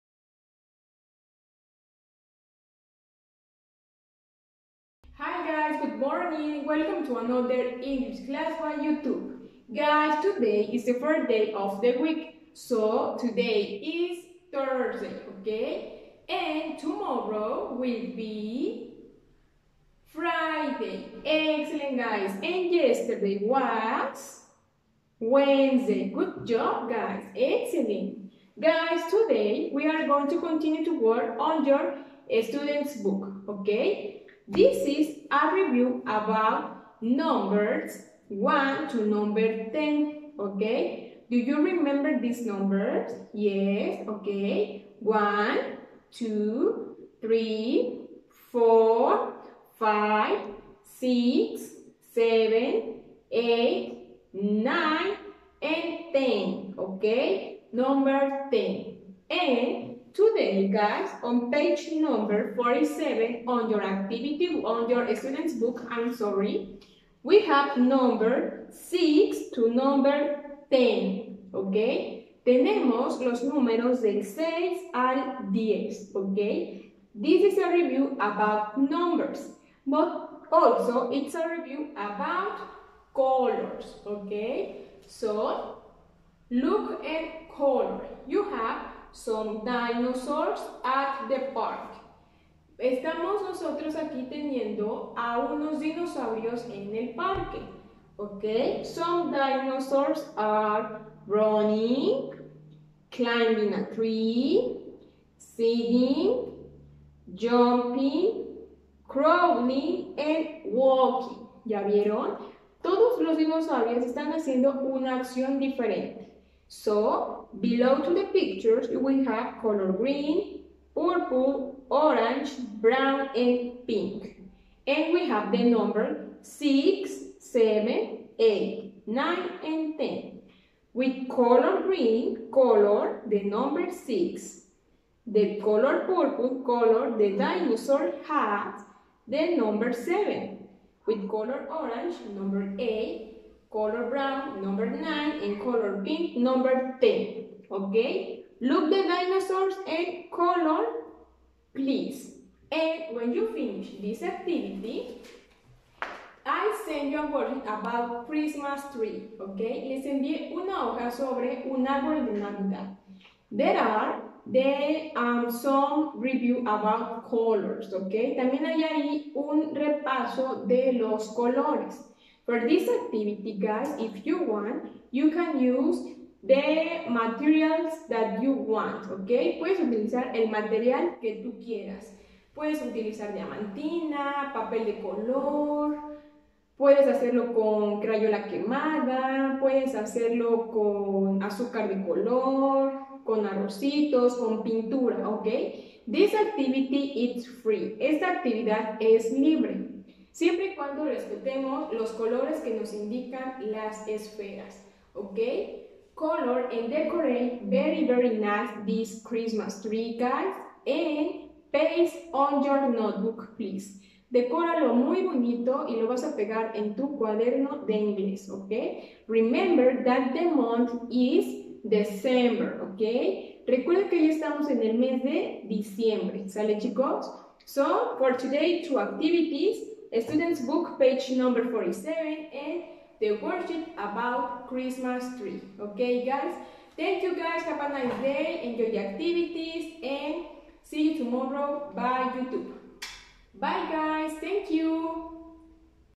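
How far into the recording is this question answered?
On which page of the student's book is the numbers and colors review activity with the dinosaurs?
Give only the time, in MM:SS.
01:01.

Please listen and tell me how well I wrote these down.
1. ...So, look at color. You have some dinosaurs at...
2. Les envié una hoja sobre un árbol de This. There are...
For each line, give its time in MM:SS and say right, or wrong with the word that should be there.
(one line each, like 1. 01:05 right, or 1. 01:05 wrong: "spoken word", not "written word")
1. 01:25 right
2. 02:39 wrong: "Navidad", not "This".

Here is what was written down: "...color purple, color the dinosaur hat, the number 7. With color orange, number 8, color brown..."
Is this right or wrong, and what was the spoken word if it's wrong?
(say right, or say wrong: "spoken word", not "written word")
right.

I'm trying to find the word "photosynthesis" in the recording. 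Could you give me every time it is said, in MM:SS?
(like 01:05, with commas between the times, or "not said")
not said.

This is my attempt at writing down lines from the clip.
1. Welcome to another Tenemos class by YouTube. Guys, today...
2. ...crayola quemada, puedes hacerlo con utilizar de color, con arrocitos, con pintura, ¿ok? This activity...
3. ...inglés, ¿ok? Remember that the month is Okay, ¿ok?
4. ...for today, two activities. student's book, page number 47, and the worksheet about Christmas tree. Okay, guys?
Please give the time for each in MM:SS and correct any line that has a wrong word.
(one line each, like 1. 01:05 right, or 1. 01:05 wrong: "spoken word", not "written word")
1. 00:06 wrong: "English", not "Tenemos"
2. 03:08 wrong: "azúcar", not "utilizar"
3. 03:37 wrong: "December", not "Okay"
4. 03:48 right.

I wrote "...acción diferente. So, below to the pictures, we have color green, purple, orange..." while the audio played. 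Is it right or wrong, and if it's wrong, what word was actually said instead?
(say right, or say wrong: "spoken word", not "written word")
right.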